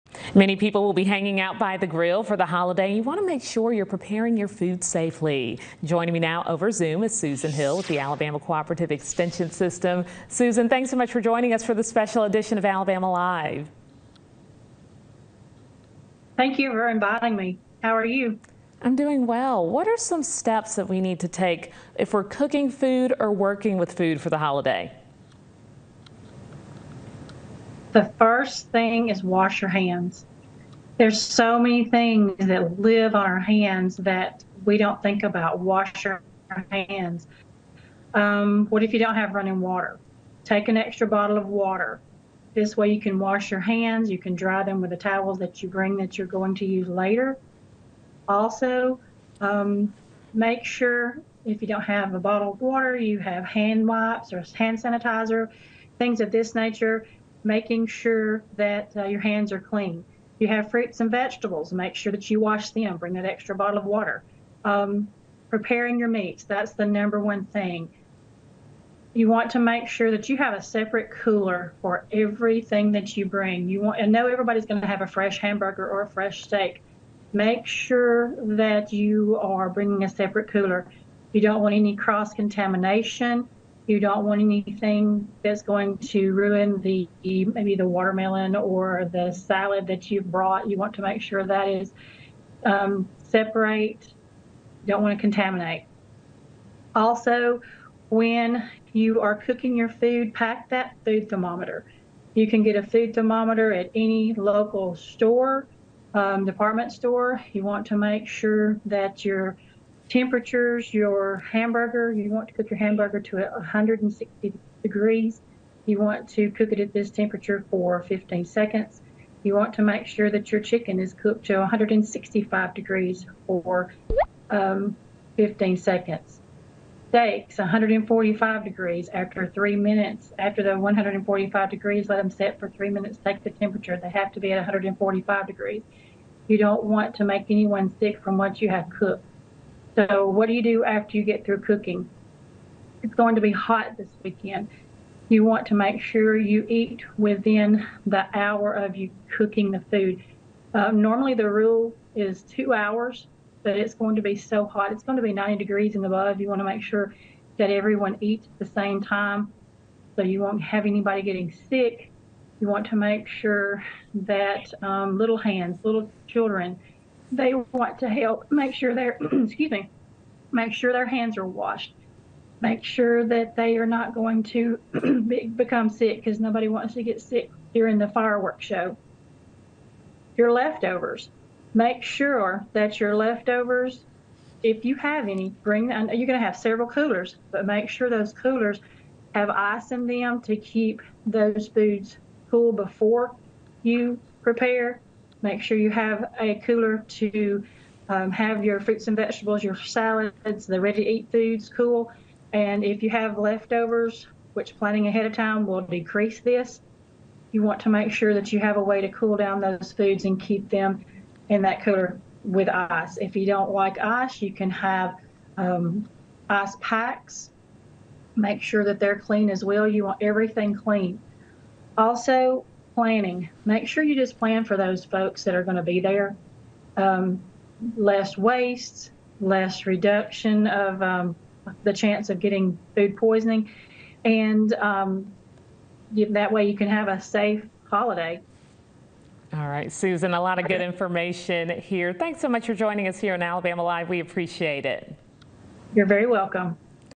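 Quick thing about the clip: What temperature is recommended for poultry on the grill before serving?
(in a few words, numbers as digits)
165 degrees.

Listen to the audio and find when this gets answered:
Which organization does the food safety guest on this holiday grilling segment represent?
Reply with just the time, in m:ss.
0:07.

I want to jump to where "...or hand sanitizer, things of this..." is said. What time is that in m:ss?
0:54.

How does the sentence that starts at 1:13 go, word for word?
You want, I know everybody's going to have a fresh hamburger or a fresh steak.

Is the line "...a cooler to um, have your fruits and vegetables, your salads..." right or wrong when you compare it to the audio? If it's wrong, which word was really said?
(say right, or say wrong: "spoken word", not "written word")
right.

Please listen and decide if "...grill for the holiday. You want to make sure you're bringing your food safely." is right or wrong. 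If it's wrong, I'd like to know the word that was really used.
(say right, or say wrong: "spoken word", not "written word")
wrong: "preparing", not "bringing".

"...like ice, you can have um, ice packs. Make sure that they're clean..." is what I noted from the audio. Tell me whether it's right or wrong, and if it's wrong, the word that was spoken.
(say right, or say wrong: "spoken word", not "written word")
right.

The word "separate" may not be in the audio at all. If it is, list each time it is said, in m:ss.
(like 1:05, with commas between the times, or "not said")
1:10, 1:20, 1:33.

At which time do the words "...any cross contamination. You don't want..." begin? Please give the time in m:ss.
1:21.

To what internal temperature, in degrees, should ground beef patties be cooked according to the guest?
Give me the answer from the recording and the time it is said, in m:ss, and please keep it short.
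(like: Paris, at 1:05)
160 degrees, at 1:53.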